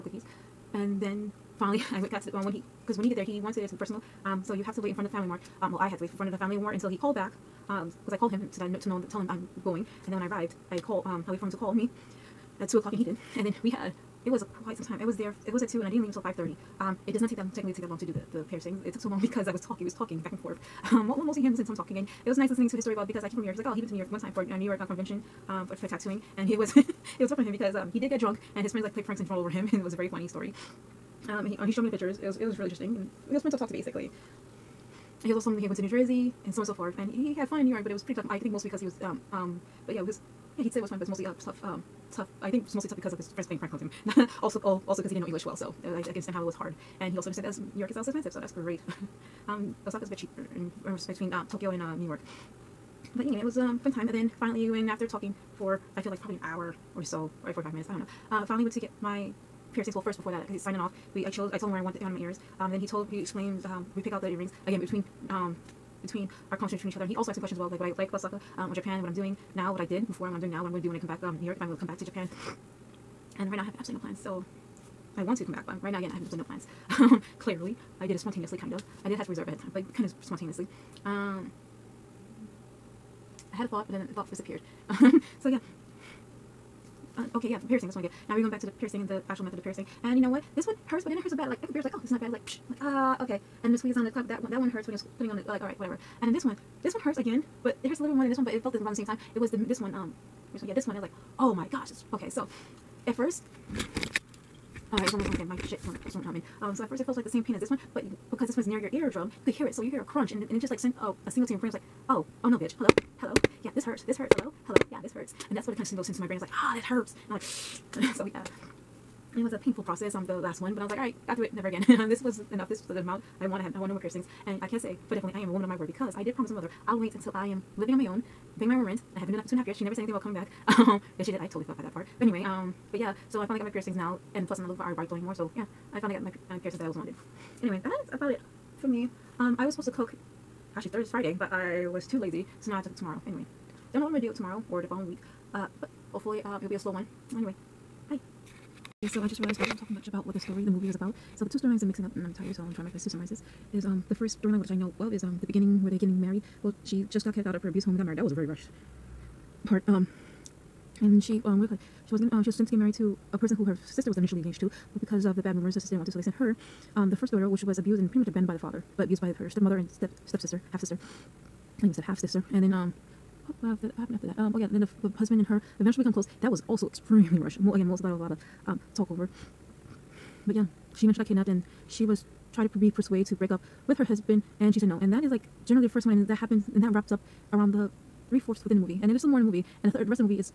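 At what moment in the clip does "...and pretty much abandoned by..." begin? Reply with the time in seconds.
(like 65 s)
167 s.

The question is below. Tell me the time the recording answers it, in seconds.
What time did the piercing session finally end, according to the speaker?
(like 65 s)
16 s.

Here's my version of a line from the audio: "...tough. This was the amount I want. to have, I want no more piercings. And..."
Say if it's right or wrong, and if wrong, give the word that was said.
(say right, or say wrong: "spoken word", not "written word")
wrong: "enough", not "tough".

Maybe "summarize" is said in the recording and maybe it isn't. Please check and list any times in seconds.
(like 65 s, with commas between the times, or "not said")
153 s.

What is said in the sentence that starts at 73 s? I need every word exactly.
And right now I have absolutely no plans.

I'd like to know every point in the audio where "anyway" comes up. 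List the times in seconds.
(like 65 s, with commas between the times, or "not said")
53 s, 132 s, 137 s, 143 s, 147 s.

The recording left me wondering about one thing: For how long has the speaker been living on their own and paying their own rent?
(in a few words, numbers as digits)
2.5 years.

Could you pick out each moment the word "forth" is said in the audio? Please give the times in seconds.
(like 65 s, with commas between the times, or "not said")
20 s, 36 s.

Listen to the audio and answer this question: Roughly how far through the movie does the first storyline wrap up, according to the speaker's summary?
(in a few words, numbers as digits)
three-fourths.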